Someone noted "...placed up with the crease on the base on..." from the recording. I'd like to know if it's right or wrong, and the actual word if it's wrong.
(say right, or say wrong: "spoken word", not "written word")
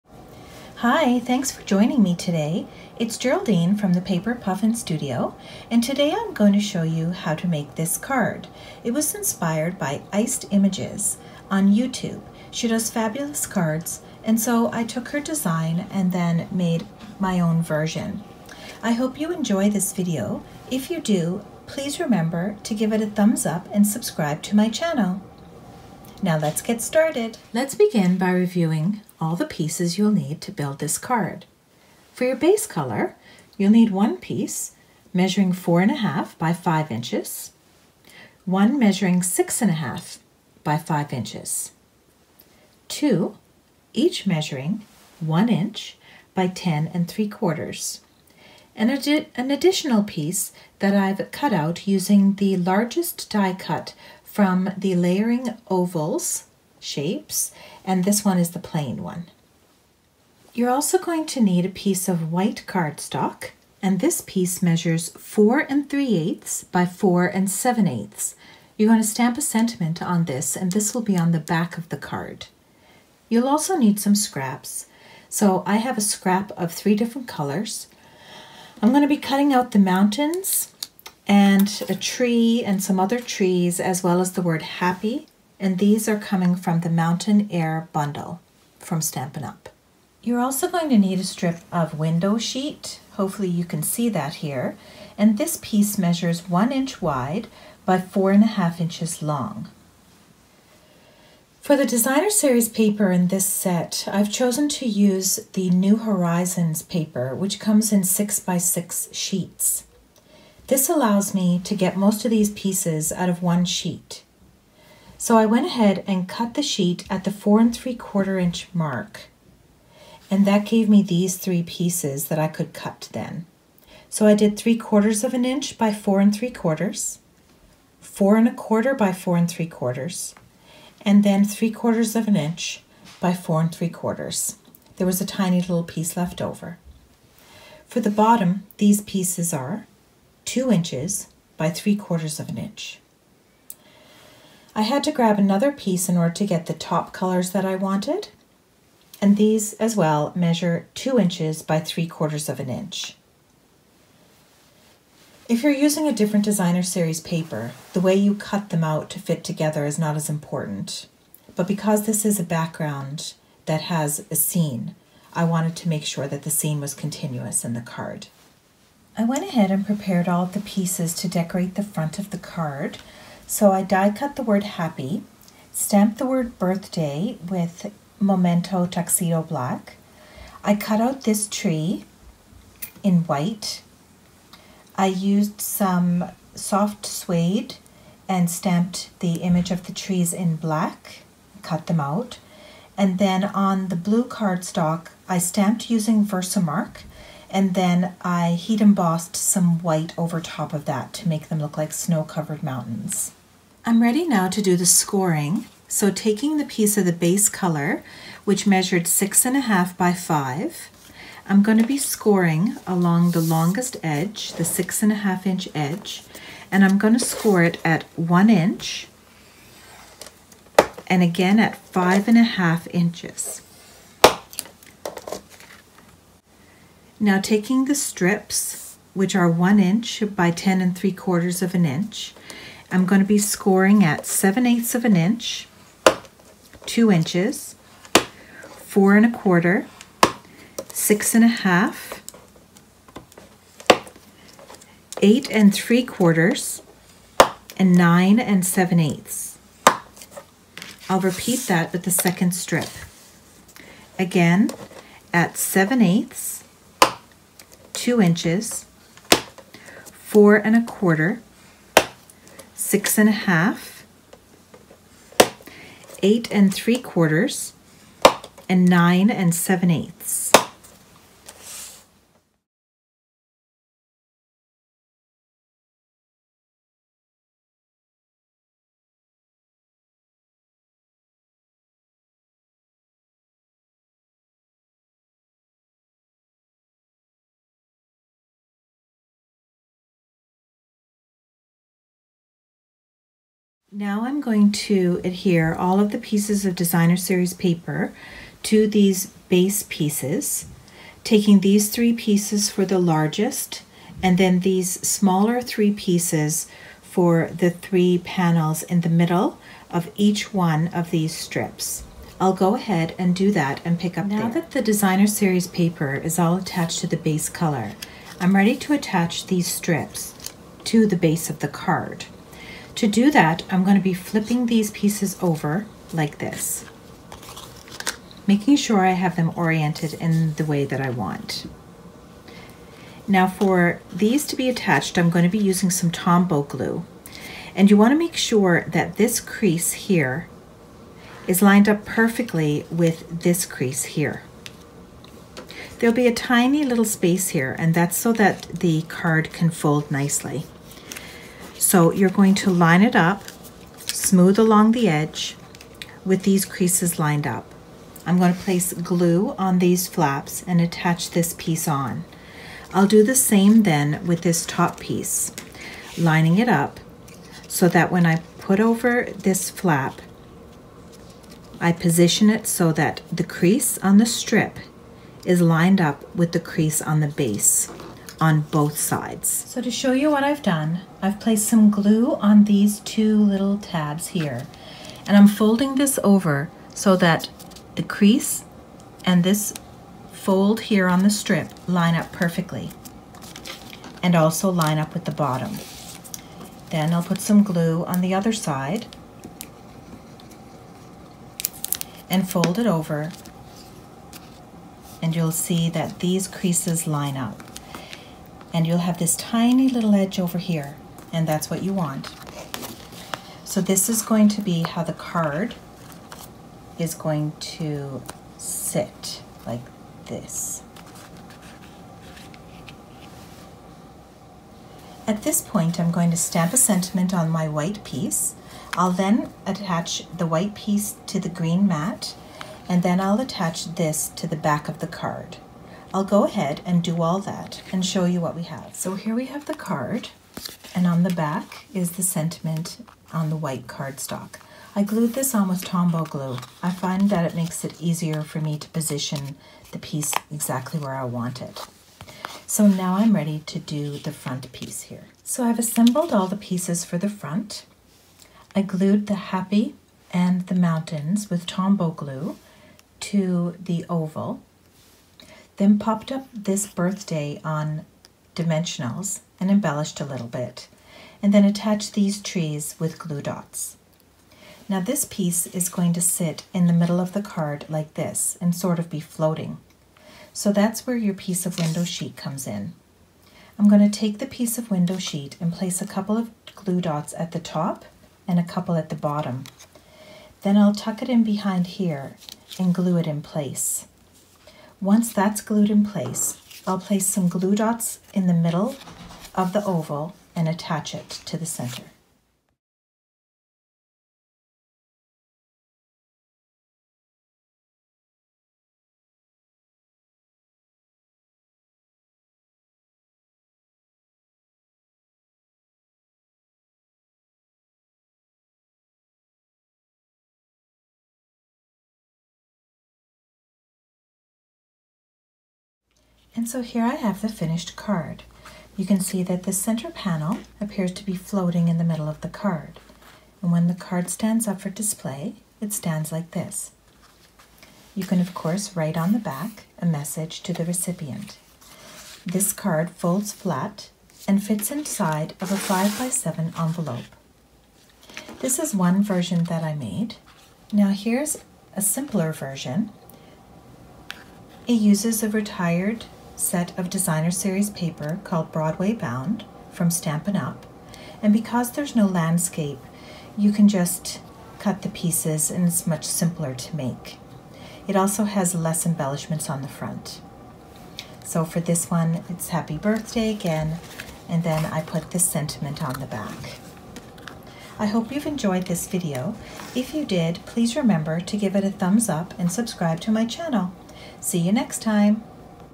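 wrong: "lined", not "placed".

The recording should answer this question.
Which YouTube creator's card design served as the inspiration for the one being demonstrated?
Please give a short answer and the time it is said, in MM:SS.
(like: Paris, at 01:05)
Iced Images, at 00:10.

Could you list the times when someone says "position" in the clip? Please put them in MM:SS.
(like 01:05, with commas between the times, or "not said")
06:11, 07:28.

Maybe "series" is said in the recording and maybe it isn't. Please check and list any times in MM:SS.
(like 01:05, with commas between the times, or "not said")
01:42, 02:36, 04:57, 05:15, 09:17.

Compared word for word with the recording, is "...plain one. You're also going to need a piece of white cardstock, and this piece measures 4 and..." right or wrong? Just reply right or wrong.
right.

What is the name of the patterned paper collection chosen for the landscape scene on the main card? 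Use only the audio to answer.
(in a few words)
New Horizons.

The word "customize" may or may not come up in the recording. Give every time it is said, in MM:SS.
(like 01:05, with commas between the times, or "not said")
not said.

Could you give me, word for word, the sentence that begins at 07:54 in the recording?
Now this piece is going to sit in the middle of the card like this and sort of be floating.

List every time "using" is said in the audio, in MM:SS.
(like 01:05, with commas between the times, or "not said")
00:51, 02:35, 03:15, 05:35.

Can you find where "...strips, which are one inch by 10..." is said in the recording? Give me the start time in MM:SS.
03:47.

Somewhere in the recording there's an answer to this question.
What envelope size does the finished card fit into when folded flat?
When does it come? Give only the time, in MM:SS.
09:05.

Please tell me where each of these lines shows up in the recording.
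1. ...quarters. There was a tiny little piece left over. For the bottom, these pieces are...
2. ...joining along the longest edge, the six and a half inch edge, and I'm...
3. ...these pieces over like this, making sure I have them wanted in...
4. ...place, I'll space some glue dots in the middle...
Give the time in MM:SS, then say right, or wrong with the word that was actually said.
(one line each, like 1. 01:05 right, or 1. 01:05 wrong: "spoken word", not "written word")
1. 02:13 right
2. 03:31 wrong: "scoring", not "joining"
3. 05:24 wrong: "oriented", not "wanted"
4. 08:16 wrong: "place", not "space".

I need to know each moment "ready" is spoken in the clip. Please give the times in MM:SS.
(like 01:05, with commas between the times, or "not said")
03:24, 05:18, 07:33.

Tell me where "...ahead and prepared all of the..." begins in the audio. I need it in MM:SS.
02:49.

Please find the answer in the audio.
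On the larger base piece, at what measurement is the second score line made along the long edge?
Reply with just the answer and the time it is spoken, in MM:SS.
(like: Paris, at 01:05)
5 1/2 inches, at 03:41.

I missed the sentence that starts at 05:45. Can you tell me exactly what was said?
There'll be a tiny little space here, and that's so that the card can fold nicely.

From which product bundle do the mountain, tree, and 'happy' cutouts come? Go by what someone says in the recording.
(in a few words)
Mountain Air Bundle.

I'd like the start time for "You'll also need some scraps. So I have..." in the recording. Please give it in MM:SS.
01:13.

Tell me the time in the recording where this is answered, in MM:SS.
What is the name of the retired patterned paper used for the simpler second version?
09:18.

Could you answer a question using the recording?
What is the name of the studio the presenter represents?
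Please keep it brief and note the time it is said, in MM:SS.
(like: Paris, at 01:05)
Paper Puffin Studio, at 00:04.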